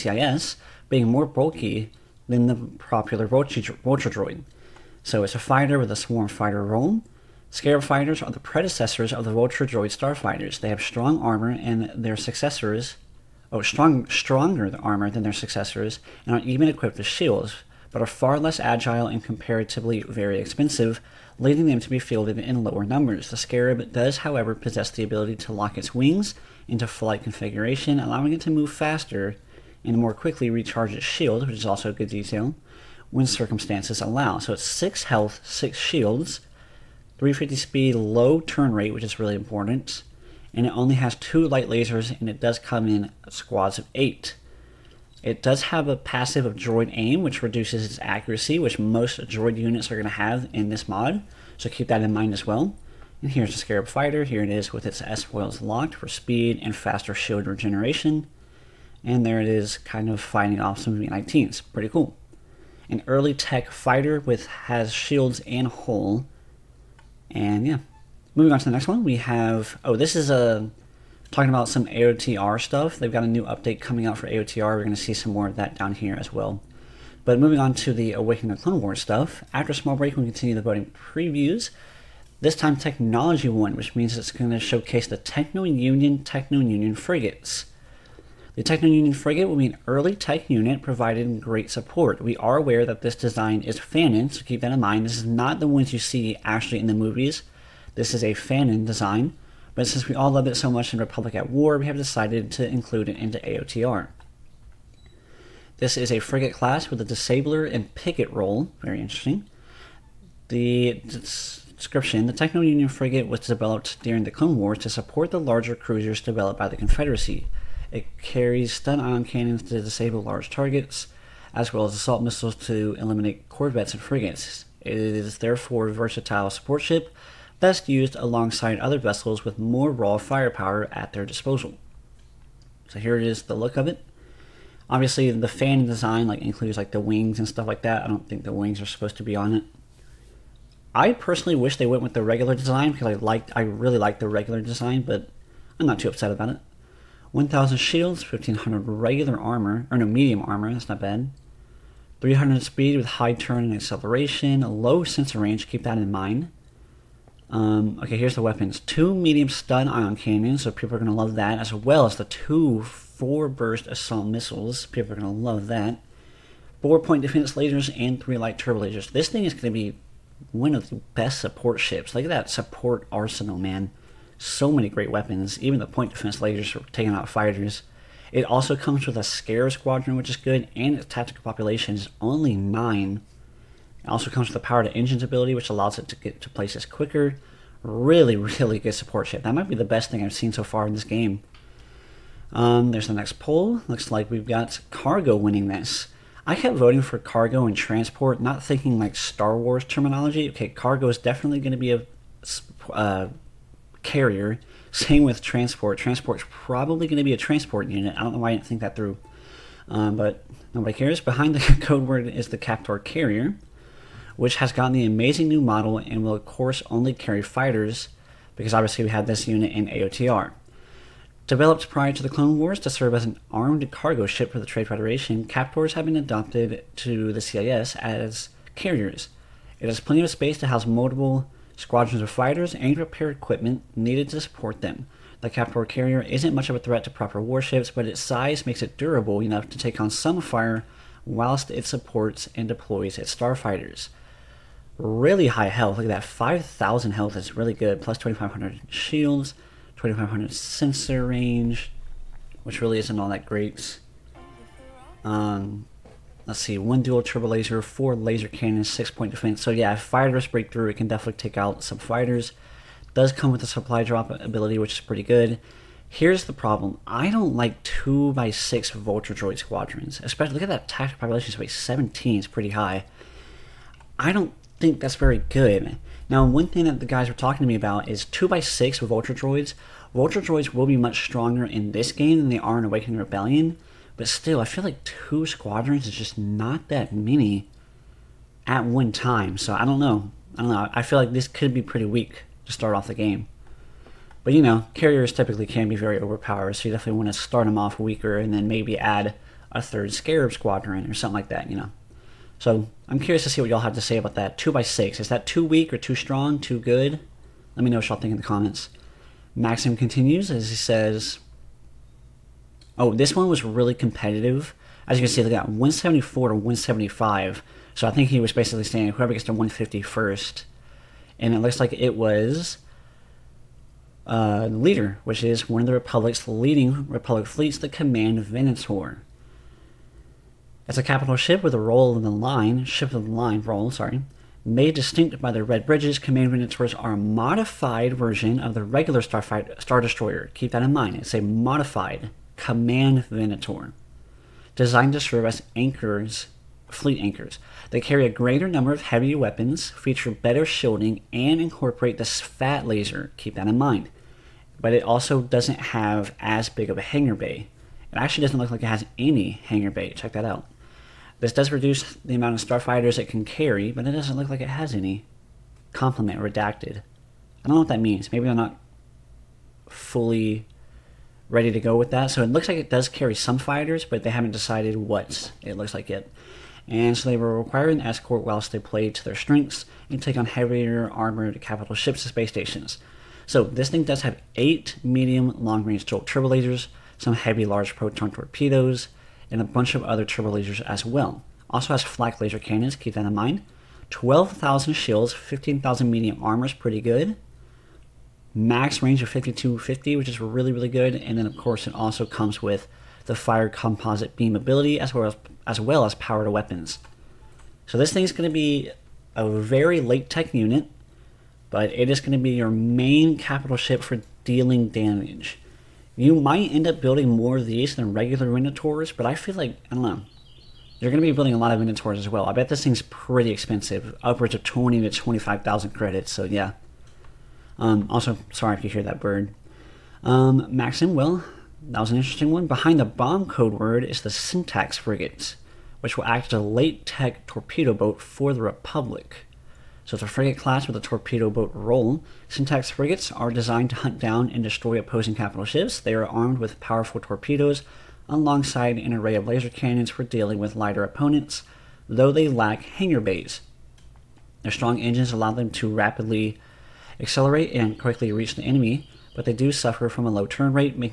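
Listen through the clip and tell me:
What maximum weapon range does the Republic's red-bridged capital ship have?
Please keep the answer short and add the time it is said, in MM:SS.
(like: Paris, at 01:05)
5250, at 06:39.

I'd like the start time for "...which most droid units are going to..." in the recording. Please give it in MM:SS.
00:48.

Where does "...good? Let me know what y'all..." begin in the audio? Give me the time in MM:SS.
05:06.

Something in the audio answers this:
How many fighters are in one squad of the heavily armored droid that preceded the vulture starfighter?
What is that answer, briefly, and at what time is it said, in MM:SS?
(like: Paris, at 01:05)
8, at 00:43.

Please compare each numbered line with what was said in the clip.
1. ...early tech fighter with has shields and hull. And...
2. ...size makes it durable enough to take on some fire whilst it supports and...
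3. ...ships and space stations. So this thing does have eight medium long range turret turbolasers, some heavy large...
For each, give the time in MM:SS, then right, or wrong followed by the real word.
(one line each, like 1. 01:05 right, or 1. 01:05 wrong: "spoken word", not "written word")
1. 01:03 right
2. 03:58 right
3. 06:21 right.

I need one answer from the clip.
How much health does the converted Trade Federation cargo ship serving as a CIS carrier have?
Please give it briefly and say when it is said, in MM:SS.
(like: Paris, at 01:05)
5,000, at 04:06.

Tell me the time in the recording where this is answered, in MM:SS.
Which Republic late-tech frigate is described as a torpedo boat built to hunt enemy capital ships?
07:14.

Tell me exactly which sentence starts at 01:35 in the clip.
This is not the ones you see actually in the movies.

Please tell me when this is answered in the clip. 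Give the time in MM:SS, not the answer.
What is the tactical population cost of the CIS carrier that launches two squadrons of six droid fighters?
04:31.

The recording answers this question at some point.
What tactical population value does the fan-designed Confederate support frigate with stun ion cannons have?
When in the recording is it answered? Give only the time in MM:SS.
03:02.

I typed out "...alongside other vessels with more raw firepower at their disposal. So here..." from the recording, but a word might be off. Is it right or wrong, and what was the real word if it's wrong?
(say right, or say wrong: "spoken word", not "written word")
right.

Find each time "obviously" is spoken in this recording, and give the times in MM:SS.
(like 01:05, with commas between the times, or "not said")
02:14, 03:38.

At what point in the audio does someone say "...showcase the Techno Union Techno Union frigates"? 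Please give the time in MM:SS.
01:24.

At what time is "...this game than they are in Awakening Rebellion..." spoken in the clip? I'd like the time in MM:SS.
04:41.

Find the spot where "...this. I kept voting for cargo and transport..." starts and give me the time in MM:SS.
03:15.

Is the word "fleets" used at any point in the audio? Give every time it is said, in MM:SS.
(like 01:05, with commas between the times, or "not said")
05:27, 05:46.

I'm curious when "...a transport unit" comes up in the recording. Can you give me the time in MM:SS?
03:27.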